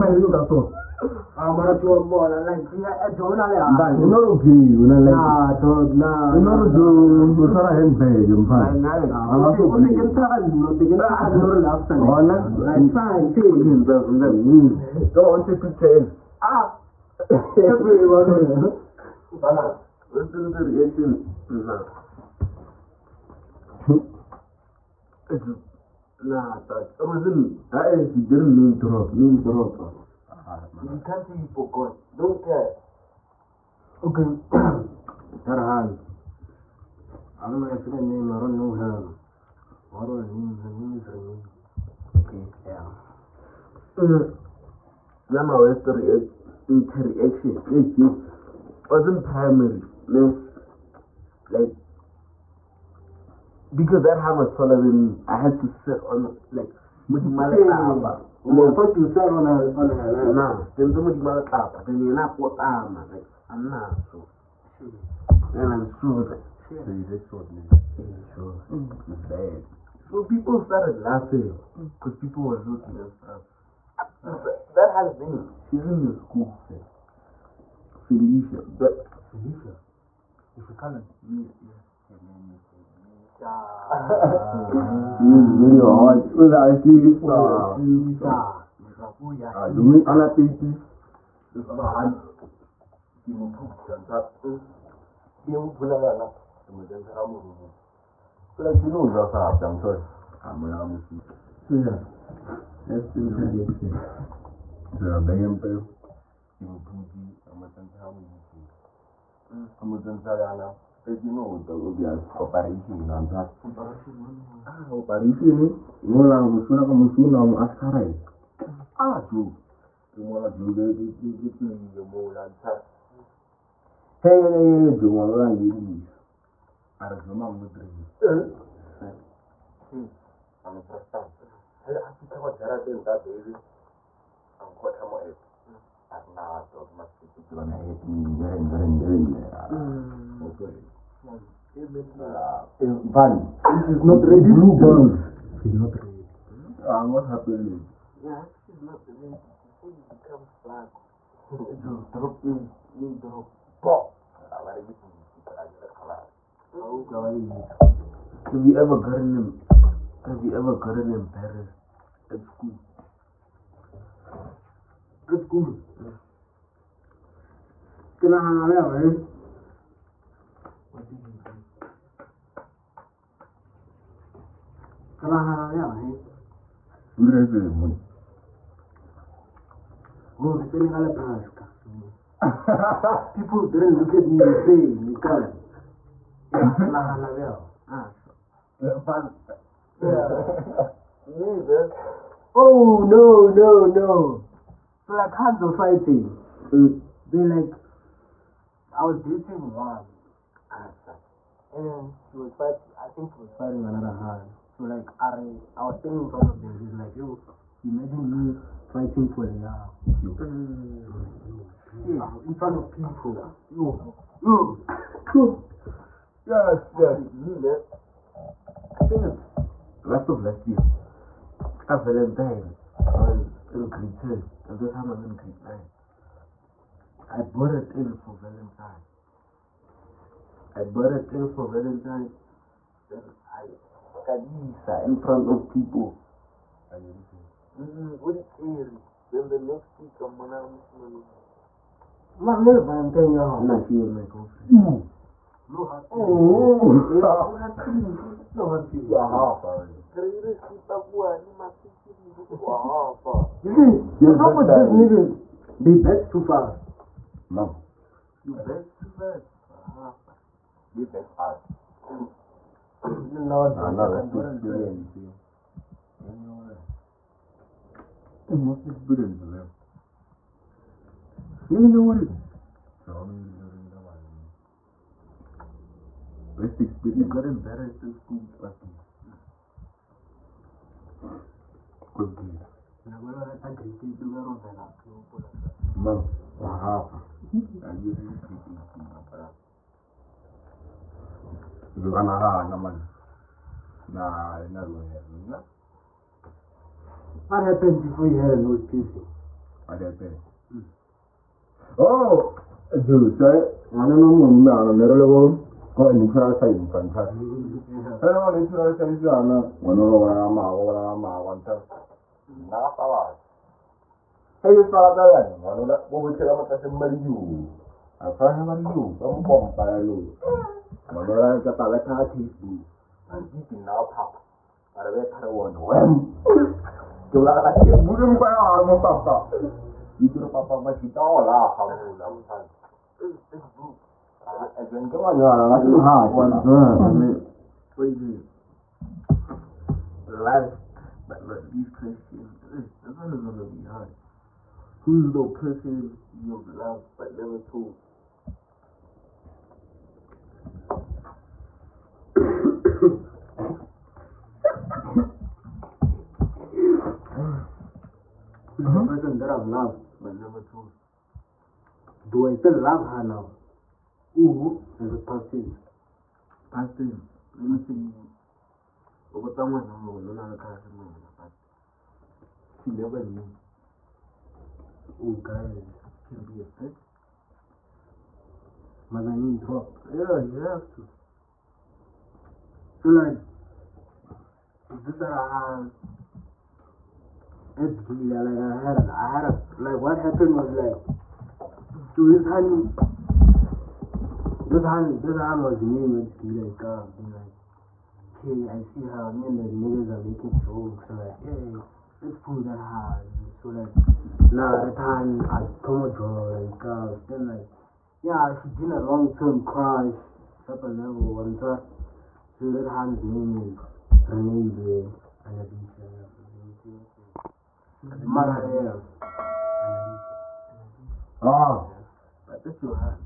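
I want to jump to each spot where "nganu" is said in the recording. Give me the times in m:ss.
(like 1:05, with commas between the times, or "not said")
5:15, 5:21.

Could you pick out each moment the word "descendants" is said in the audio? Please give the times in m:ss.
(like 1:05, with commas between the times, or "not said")
not said.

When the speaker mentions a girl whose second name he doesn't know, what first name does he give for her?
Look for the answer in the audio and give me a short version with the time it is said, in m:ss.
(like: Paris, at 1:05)
Remy, at 0:40.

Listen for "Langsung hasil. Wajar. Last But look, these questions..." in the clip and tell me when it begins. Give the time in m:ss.
5:35.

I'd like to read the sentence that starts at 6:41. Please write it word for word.
So like, hey, let's pull that hard.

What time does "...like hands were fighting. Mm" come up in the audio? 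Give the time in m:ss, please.
3:15.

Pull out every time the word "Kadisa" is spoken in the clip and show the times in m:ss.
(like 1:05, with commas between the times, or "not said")
3:54.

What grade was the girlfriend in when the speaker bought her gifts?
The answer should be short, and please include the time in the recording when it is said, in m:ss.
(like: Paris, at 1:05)
grade 9, at 3:45.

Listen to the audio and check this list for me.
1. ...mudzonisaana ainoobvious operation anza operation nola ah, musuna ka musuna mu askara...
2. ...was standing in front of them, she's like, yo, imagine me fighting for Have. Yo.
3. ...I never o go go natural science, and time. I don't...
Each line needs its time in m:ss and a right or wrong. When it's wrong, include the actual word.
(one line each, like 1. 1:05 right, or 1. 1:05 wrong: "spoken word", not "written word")
1. 1:49 right
2. 3:25 wrong: "Leah", not "Have"
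3. 5:04 right.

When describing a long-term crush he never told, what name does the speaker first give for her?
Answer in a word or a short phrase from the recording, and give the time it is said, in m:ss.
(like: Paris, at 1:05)
Renee, at 6:54.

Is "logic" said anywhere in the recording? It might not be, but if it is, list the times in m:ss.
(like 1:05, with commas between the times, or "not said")
not said.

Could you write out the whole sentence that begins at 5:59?
person that I've loved but never told?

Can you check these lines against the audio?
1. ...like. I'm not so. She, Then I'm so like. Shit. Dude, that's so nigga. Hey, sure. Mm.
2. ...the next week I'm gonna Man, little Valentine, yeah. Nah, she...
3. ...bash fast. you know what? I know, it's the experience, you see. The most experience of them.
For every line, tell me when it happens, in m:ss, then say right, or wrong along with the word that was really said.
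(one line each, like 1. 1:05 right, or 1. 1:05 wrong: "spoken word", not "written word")
1. 1:02 right
2. 3:59 right
3. 4:21 right.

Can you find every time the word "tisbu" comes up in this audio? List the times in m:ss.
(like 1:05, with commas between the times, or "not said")
5:22, 5:27.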